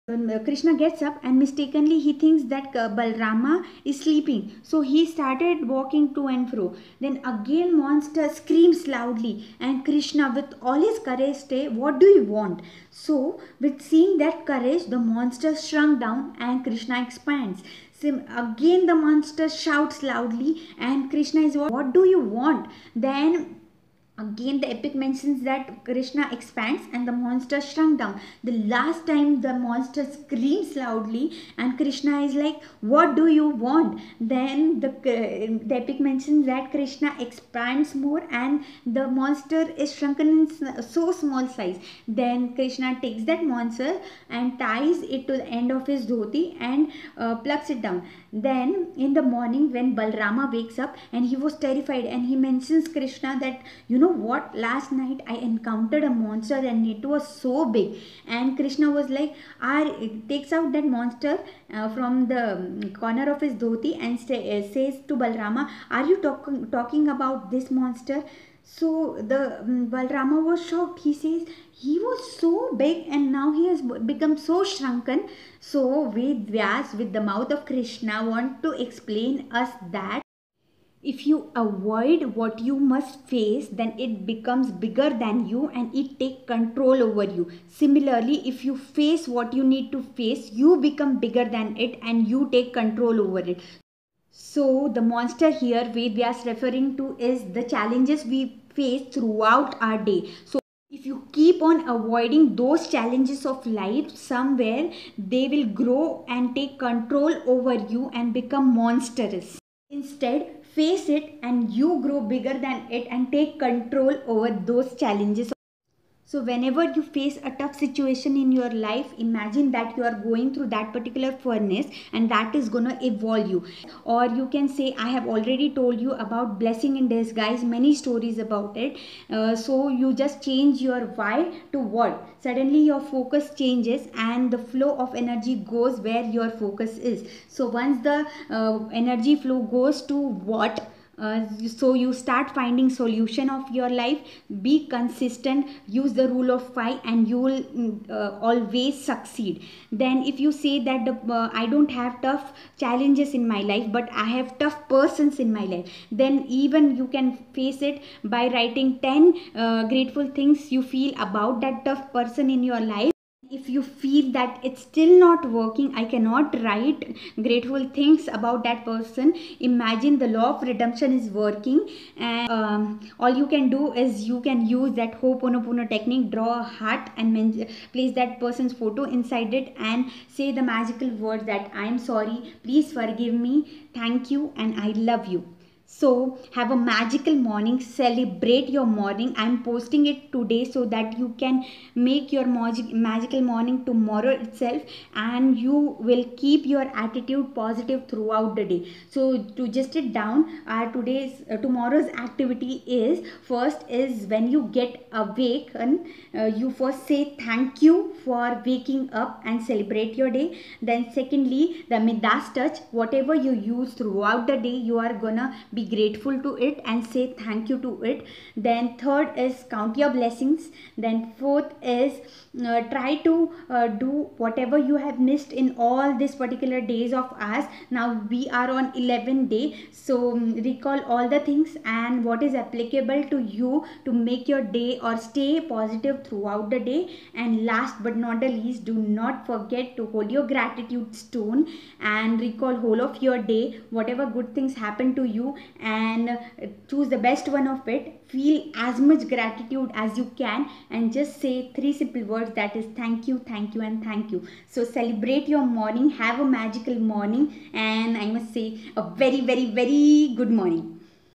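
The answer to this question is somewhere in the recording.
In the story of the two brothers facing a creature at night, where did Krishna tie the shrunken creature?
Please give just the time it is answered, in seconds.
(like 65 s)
45 s.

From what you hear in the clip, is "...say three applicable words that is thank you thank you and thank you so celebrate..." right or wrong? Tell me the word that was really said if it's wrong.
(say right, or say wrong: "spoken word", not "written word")
wrong: "simple", not "applicable".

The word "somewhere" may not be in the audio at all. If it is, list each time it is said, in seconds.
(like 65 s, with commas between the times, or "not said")
104 s.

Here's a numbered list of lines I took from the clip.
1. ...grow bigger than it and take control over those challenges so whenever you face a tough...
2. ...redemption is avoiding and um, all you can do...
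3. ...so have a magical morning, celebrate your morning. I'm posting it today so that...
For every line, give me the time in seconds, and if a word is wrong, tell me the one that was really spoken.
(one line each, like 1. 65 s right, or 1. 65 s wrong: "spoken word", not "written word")
1. 112 s right
2. 170 s wrong: "working", not "avoiding"
3. 185 s right.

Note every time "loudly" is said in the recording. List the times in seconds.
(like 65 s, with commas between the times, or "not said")
8 s, 20 s, 30 s.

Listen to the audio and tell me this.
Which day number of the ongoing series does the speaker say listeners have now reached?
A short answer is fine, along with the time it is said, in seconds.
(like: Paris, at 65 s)
11, at 228 s.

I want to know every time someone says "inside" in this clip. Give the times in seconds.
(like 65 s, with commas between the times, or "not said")
179 s.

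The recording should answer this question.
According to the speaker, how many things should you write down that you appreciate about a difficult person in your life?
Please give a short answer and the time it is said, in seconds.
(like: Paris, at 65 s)
10, at 158 s.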